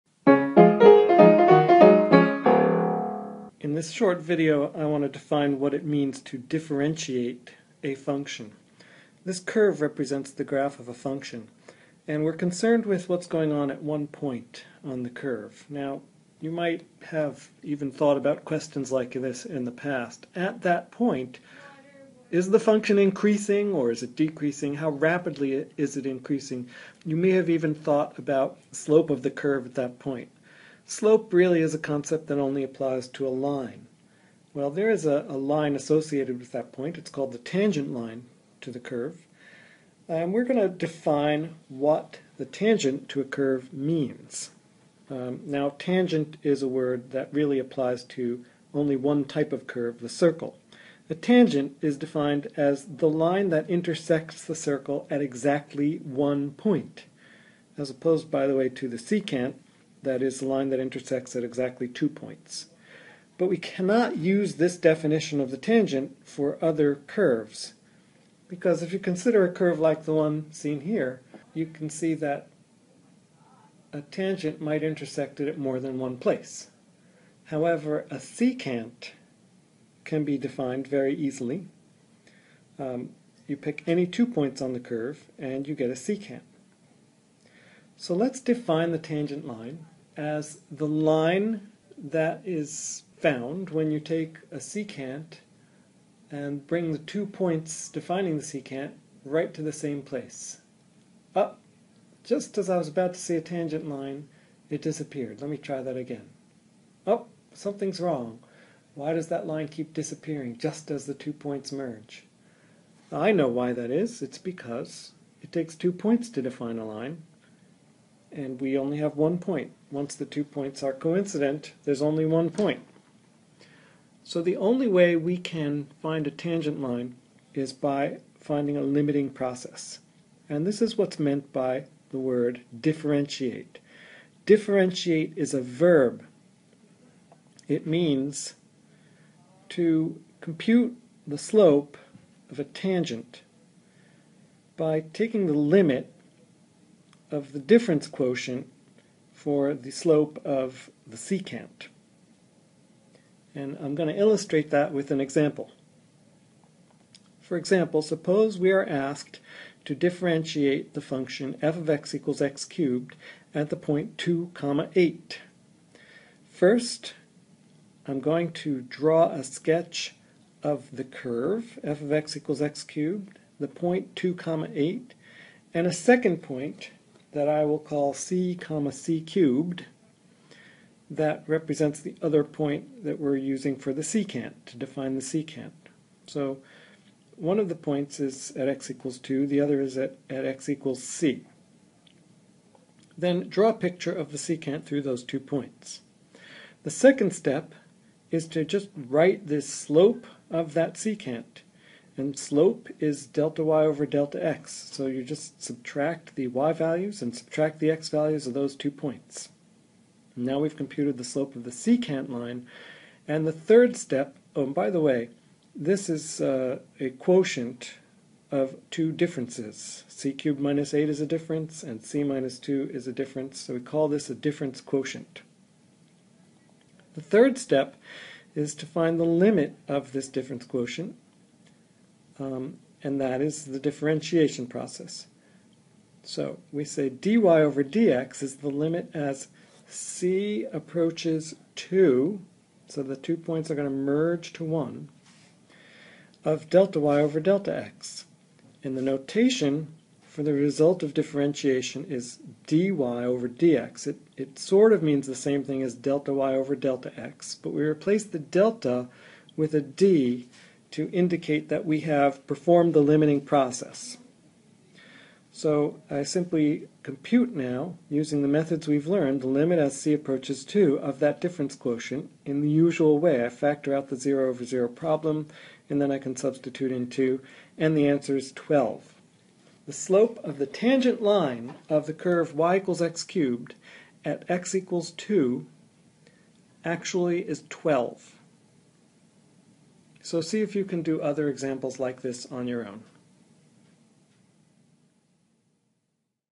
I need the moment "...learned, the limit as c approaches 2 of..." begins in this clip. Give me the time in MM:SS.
04:29.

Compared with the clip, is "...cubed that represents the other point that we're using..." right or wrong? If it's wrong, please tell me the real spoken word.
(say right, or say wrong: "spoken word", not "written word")
right.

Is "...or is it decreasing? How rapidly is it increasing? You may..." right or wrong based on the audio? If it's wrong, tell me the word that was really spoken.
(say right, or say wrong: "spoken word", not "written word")
right.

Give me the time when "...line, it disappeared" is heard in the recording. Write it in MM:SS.
01:43.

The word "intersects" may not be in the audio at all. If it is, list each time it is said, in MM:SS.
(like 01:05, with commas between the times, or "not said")
00:53, 01:00, 01:14.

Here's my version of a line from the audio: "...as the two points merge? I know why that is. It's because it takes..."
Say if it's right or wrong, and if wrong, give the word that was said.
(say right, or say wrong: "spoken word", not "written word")
right.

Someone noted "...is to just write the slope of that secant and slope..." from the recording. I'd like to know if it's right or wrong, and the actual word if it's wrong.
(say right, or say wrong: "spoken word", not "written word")
right.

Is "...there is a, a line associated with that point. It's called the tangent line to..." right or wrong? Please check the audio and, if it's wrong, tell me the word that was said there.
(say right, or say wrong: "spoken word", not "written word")
right.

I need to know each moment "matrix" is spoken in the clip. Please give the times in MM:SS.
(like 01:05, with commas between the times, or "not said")
not said.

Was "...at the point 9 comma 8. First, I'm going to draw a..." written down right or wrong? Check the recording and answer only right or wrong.
wrong.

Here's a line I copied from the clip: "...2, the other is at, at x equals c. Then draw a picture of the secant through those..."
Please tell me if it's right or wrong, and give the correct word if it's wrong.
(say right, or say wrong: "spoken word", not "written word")
right.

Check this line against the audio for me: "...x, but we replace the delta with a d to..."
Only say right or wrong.
right.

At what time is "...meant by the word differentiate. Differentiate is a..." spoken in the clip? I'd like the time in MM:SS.
02:11.